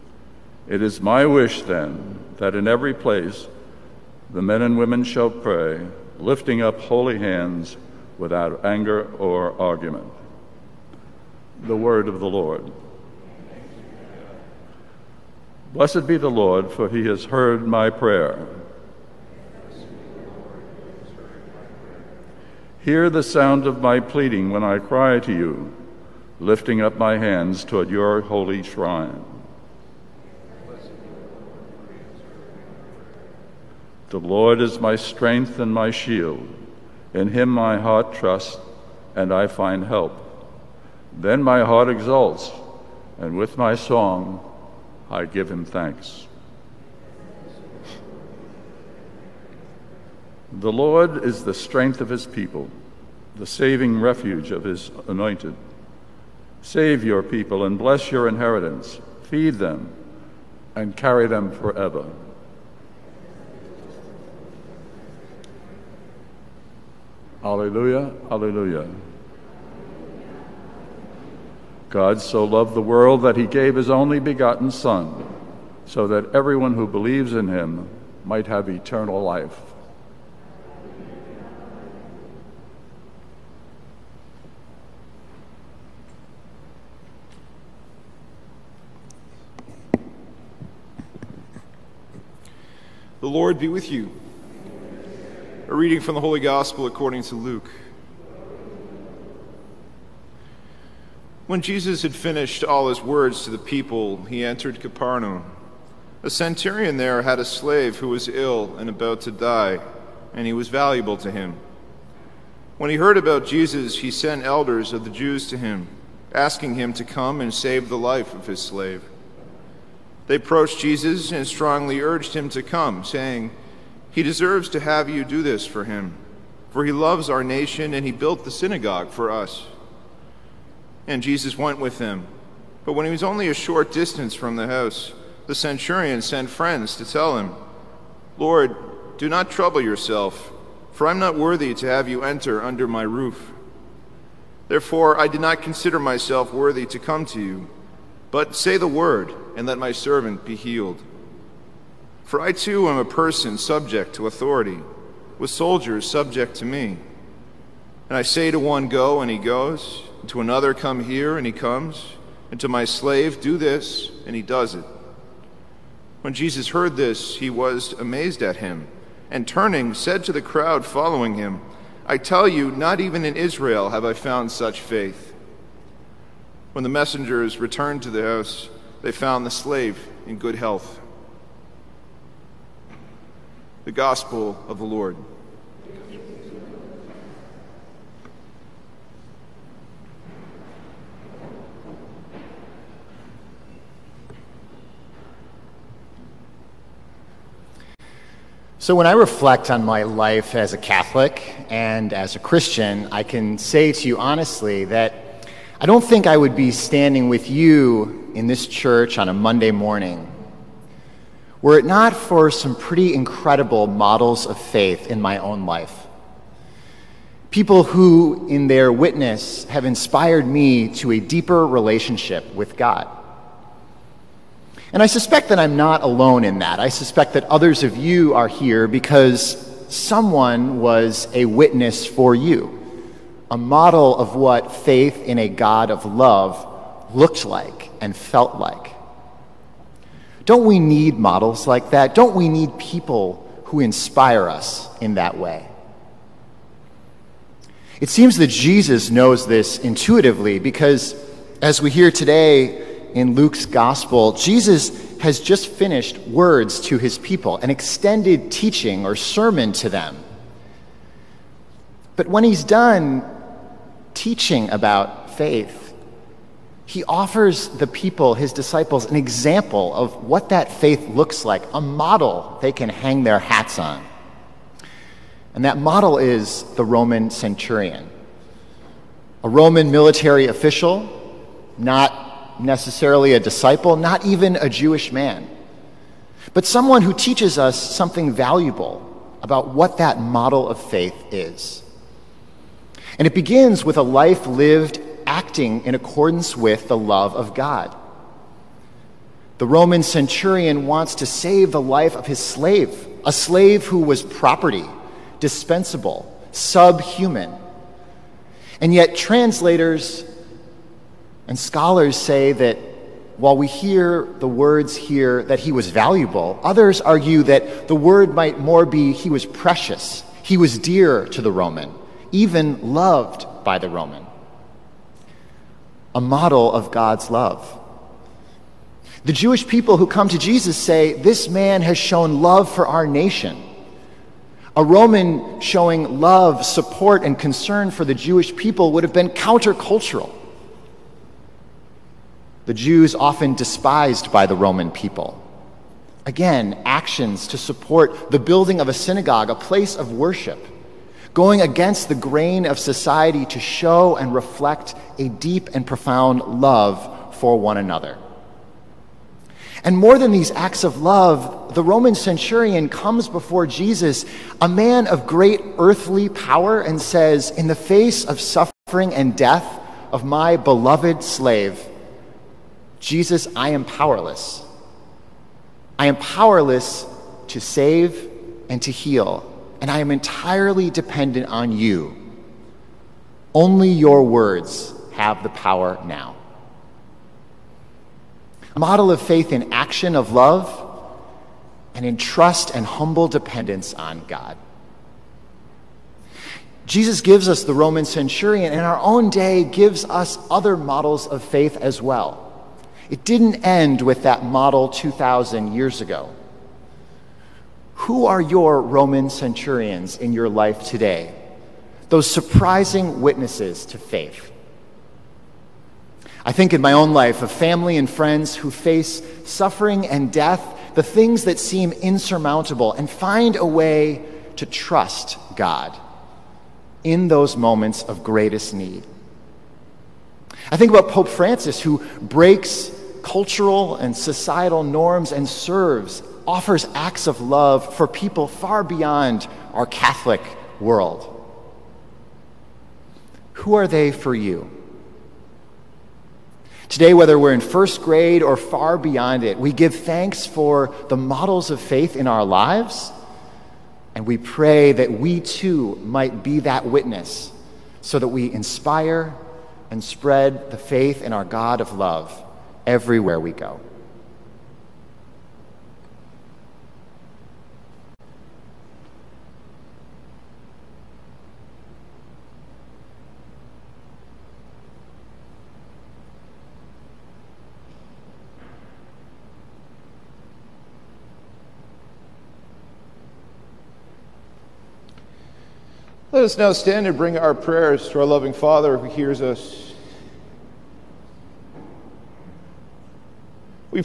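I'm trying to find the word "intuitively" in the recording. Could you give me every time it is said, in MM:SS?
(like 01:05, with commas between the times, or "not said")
04:09.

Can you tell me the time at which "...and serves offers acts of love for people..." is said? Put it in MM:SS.
07:15.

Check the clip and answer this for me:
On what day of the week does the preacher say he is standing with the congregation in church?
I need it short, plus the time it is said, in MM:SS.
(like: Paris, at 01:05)
Monday, at 03:29.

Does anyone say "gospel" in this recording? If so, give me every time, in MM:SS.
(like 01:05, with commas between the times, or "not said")
01:36, 03:03, 04:13.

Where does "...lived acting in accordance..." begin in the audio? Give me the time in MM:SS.
04:54.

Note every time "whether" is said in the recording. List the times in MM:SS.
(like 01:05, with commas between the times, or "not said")
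07:27.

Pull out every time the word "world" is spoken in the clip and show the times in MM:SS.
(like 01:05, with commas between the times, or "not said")
01:12, 07:20.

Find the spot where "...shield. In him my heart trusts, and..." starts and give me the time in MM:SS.
00:35.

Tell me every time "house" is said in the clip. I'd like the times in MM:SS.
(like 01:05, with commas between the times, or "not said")
02:14, 02:58.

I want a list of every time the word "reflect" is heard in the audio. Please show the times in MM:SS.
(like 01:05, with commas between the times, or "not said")
03:19, 05:54.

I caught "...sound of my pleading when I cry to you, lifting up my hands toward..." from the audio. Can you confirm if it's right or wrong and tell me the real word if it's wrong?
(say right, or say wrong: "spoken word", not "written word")
right.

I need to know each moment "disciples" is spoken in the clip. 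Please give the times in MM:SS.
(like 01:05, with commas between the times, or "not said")
04:28, 04:43.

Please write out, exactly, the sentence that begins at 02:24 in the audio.
Therefore, I did not consider myself worthy to come to you, but say the word and let my servant be healed.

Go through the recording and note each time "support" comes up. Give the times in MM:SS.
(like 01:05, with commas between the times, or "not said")
05:36, 05:47.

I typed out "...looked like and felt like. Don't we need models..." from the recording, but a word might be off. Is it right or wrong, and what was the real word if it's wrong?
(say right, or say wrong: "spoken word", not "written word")
right.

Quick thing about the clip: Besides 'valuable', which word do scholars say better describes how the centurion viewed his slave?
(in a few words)
Precious.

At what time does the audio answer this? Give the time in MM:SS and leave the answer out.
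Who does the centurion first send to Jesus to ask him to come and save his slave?
01:54.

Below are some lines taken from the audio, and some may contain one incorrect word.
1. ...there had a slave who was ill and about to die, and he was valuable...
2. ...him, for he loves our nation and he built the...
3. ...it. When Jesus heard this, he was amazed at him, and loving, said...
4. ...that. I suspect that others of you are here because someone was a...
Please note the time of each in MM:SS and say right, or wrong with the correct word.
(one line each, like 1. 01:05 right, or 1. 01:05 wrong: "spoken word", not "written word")
1. 01:46 right
2. 02:05 right
3. 02:44 wrong: "turning", not "loving"
4. 03:46 right.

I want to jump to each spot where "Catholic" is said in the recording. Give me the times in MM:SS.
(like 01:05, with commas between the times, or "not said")
03:20, 07:19.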